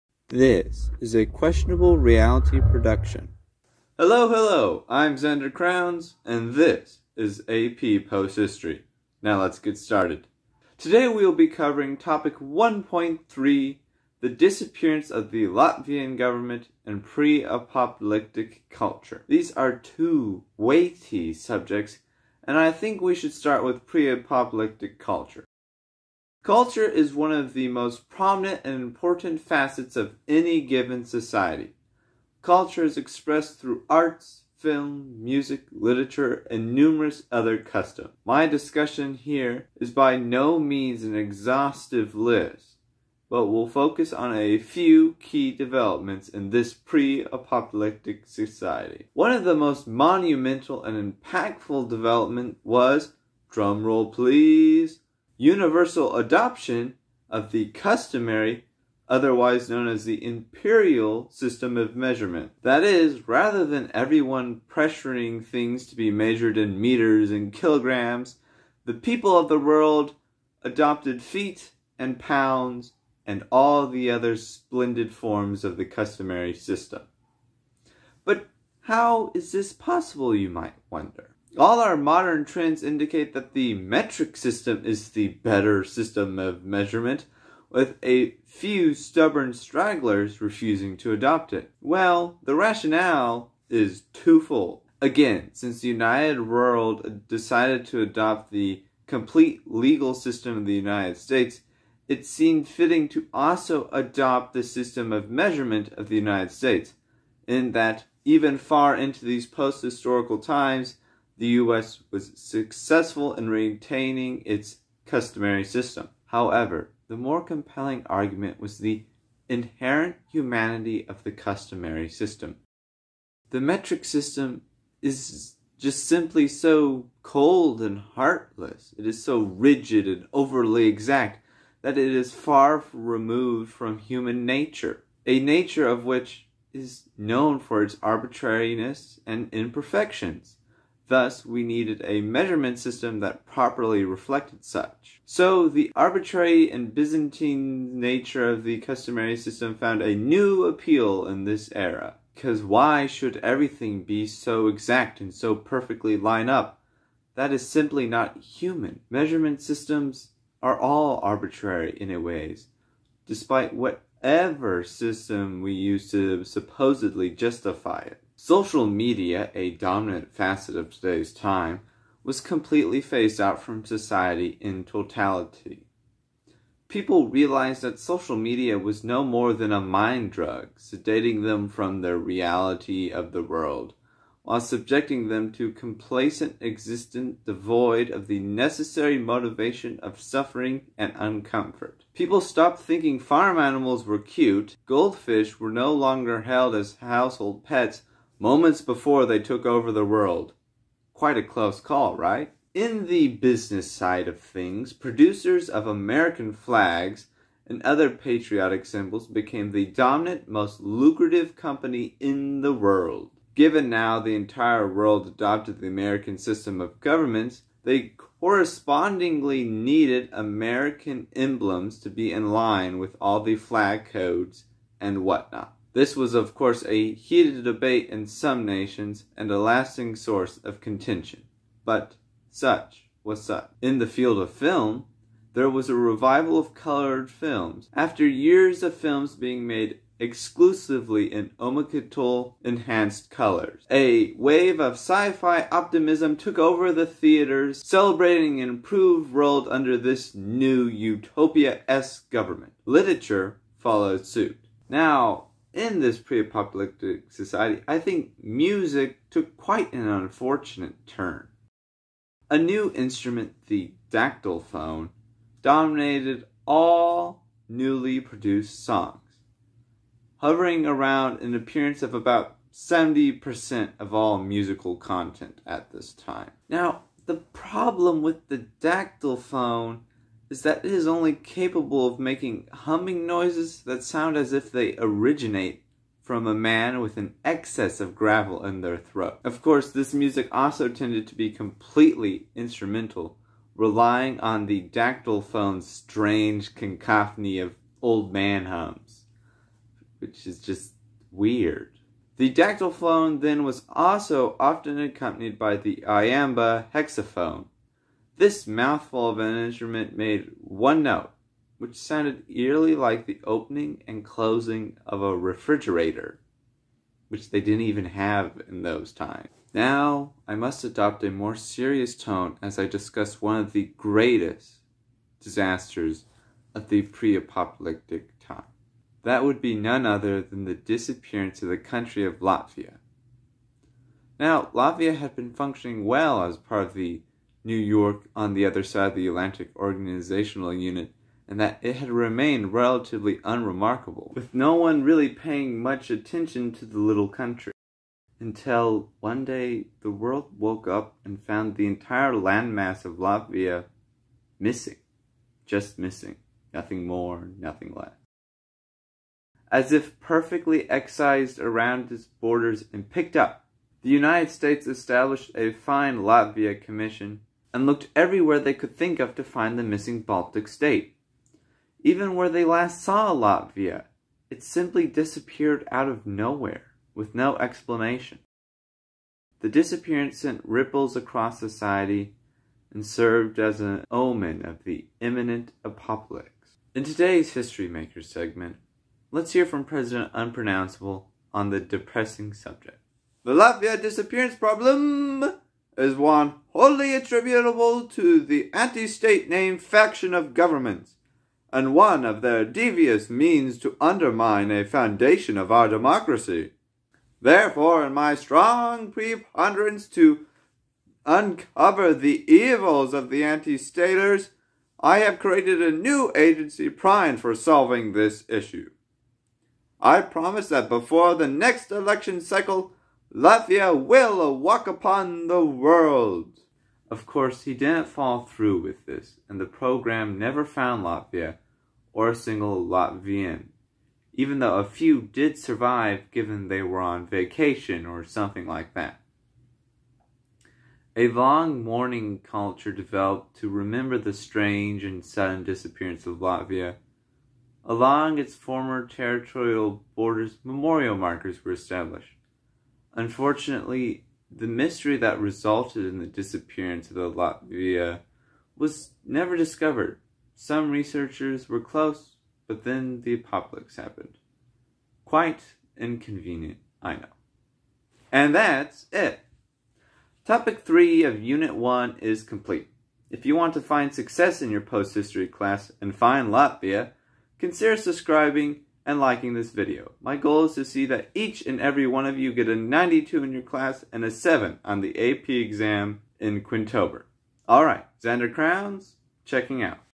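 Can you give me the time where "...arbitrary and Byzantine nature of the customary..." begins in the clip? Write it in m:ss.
2:25.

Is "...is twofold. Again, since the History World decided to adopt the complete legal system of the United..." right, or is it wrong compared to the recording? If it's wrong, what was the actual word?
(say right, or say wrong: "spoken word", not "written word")
wrong: "United", not "History".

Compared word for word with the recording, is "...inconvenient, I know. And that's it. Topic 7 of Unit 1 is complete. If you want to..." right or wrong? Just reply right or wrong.
wrong.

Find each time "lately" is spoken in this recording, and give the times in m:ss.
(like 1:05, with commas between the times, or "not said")
not said.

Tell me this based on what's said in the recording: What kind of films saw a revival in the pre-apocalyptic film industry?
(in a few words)
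colored films.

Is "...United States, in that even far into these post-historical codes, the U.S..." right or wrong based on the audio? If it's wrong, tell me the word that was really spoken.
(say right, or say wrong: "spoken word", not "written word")
wrong: "times", not "codes".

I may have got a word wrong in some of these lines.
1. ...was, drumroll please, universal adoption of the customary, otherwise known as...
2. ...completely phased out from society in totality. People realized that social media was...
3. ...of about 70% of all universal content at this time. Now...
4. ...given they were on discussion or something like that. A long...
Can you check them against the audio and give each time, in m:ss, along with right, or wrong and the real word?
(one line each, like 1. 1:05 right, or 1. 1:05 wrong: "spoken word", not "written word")
1. 0:52 right
2. 2:52 right
3. 4:32 wrong: "musical", not "universal"
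4. 7:16 wrong: "vacation", not "discussion".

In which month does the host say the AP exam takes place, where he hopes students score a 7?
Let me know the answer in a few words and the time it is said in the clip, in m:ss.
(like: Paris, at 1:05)
Quintober, at 8:06.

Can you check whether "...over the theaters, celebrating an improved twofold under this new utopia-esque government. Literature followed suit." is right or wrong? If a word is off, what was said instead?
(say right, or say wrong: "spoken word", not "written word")
wrong: "world", not "twofold".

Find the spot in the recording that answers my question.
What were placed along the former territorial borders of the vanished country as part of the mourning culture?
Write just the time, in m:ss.
7:30.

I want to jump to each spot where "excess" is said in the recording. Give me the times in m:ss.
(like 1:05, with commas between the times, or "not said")
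4:47.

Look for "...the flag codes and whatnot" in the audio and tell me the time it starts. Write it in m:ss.
3:43.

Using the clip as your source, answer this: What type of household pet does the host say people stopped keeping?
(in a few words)
goldfish.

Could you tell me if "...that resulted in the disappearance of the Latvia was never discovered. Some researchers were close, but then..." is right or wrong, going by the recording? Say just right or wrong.
right.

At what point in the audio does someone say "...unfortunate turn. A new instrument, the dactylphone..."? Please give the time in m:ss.
4:20.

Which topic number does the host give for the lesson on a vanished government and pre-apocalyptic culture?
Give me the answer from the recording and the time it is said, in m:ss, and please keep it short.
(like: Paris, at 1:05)
1.3, at 0:12.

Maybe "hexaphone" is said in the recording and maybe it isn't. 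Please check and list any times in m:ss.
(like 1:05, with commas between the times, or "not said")
5:06.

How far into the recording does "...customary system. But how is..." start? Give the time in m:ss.
1:15.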